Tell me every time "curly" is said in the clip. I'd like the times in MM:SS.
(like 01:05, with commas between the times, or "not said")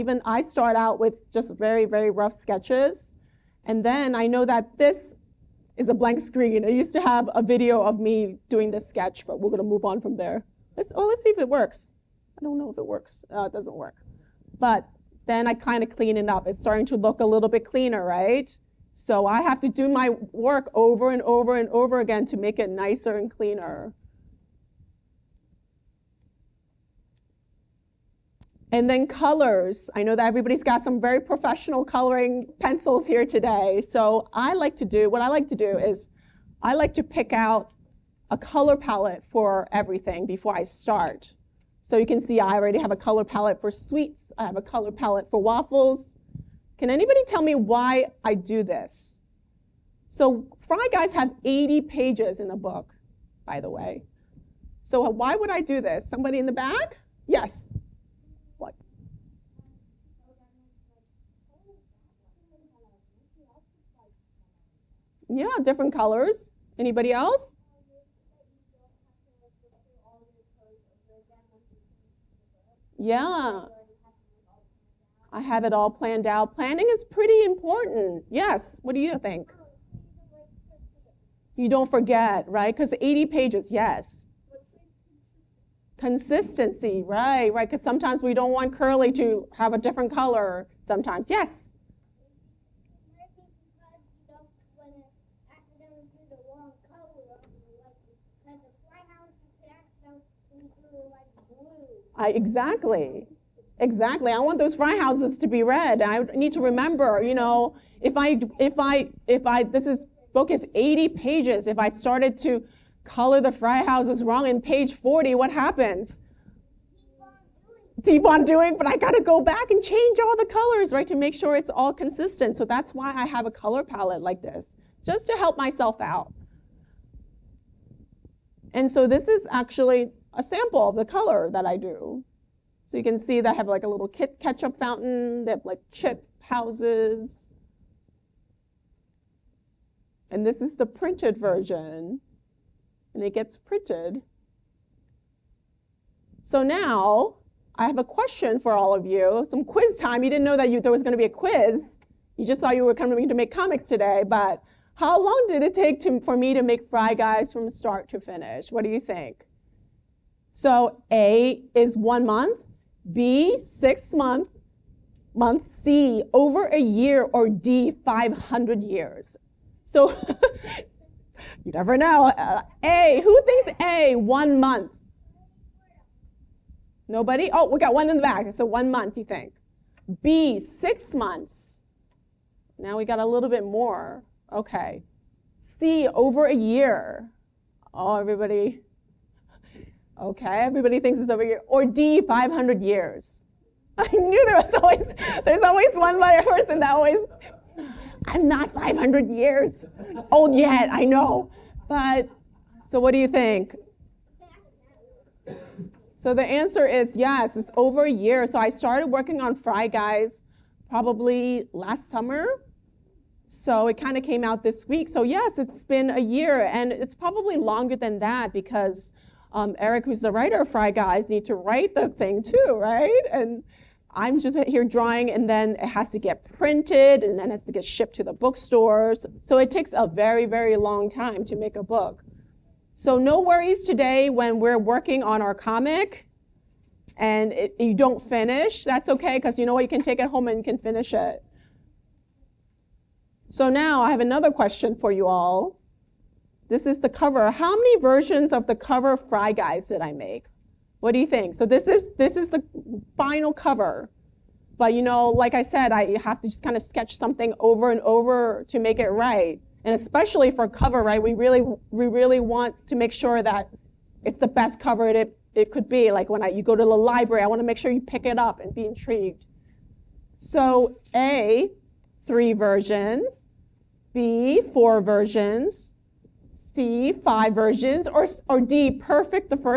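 01:28.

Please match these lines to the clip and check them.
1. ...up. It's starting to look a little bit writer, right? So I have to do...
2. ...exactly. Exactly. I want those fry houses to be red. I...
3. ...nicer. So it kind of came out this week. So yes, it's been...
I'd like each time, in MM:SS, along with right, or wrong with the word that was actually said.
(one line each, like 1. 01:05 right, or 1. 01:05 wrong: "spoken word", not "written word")
1. 00:16 wrong: "cleaner", not "writer"
2. 01:42 right
3. 03:32 wrong: "summer", not "nicer".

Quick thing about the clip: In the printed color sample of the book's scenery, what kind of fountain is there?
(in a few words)
Ketchup fountain.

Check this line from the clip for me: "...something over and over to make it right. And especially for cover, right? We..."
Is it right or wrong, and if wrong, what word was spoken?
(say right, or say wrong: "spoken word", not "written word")
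right.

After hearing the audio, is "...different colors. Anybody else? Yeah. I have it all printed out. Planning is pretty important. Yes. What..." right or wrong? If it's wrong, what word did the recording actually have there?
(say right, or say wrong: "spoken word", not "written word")
wrong: "planned", not "printed".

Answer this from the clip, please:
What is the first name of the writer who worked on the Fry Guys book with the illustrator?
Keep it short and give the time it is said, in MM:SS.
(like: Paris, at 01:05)
Eric, at 03:39.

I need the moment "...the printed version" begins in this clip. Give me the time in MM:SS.
02:20.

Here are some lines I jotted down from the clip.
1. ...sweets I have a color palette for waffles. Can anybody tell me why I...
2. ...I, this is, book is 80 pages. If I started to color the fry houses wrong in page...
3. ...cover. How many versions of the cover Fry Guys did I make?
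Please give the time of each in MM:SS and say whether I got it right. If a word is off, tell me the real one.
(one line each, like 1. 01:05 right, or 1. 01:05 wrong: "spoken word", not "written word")
1. 00:43 right
2. 01:49 right
3. 04:07 right.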